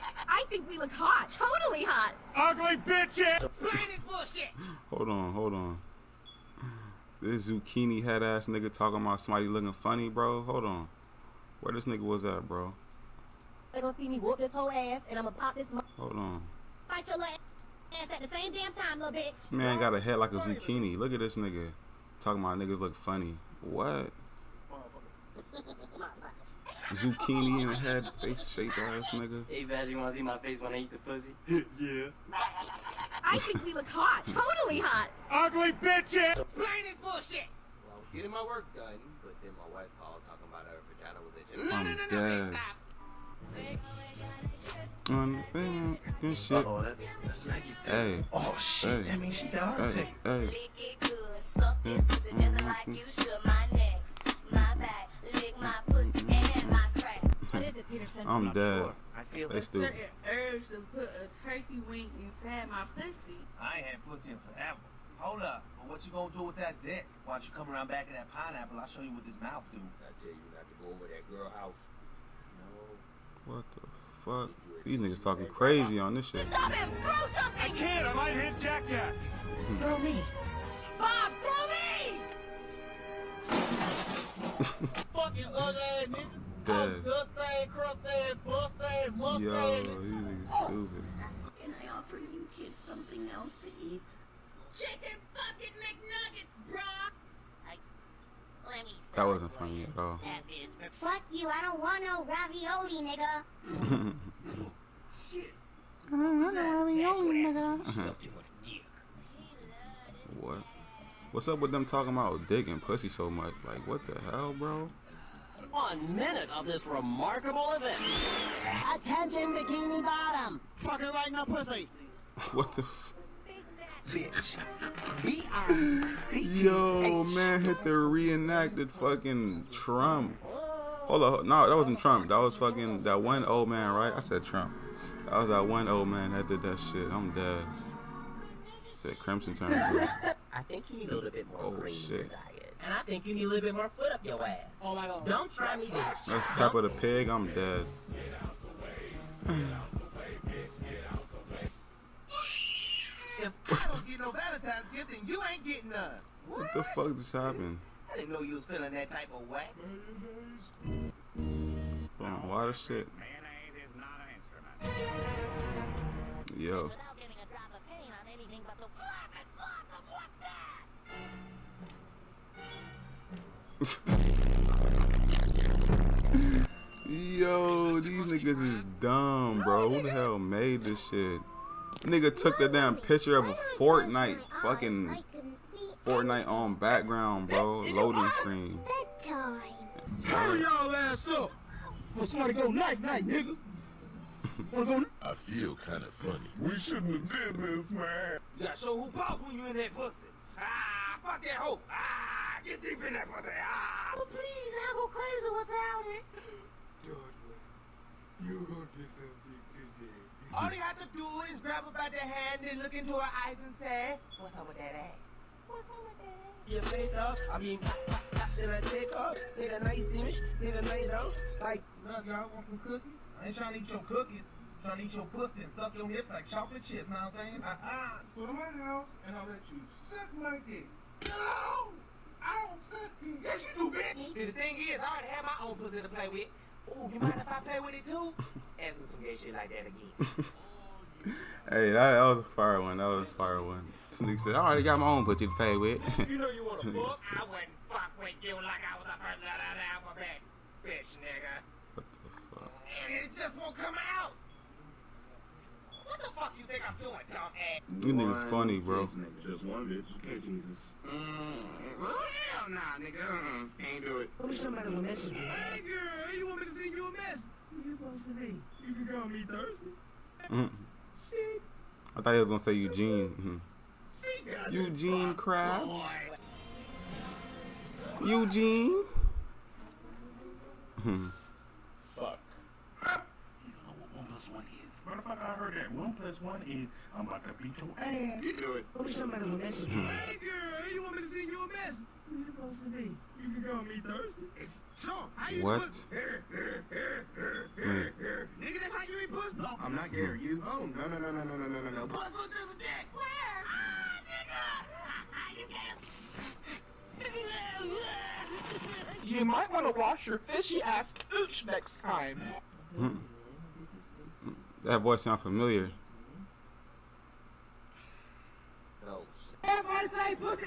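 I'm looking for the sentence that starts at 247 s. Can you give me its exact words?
I wouldn't fuck with you like I was the first letter of the alphabet, bitch nigga.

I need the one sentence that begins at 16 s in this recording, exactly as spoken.
Fight your ass at the same damn time, little bitch.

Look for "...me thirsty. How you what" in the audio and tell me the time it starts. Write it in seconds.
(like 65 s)
293 s.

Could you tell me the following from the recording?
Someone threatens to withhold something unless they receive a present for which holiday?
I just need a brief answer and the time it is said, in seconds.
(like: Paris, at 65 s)
Valentine's, at 154 s.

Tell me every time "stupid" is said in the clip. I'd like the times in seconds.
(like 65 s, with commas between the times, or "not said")
59 s, 90 s.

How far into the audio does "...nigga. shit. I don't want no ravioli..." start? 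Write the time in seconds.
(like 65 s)
103 s.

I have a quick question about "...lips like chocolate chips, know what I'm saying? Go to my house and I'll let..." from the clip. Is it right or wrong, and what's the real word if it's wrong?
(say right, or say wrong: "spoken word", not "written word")
right.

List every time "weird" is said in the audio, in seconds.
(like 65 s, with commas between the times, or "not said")
not said.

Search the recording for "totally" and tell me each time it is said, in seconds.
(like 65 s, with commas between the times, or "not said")
1 s, 34 s.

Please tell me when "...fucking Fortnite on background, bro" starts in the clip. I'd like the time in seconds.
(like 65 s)
184 s.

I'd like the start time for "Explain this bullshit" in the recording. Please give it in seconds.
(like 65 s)
36 s.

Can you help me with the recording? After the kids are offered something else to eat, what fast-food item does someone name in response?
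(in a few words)
Chicken bucket McNuggets.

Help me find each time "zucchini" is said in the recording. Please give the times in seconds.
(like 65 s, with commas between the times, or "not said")
7 s, 20 s, 26 s.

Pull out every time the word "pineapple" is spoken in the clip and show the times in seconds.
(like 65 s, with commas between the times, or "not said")
68 s.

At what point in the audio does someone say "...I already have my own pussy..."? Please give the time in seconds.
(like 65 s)
235 s.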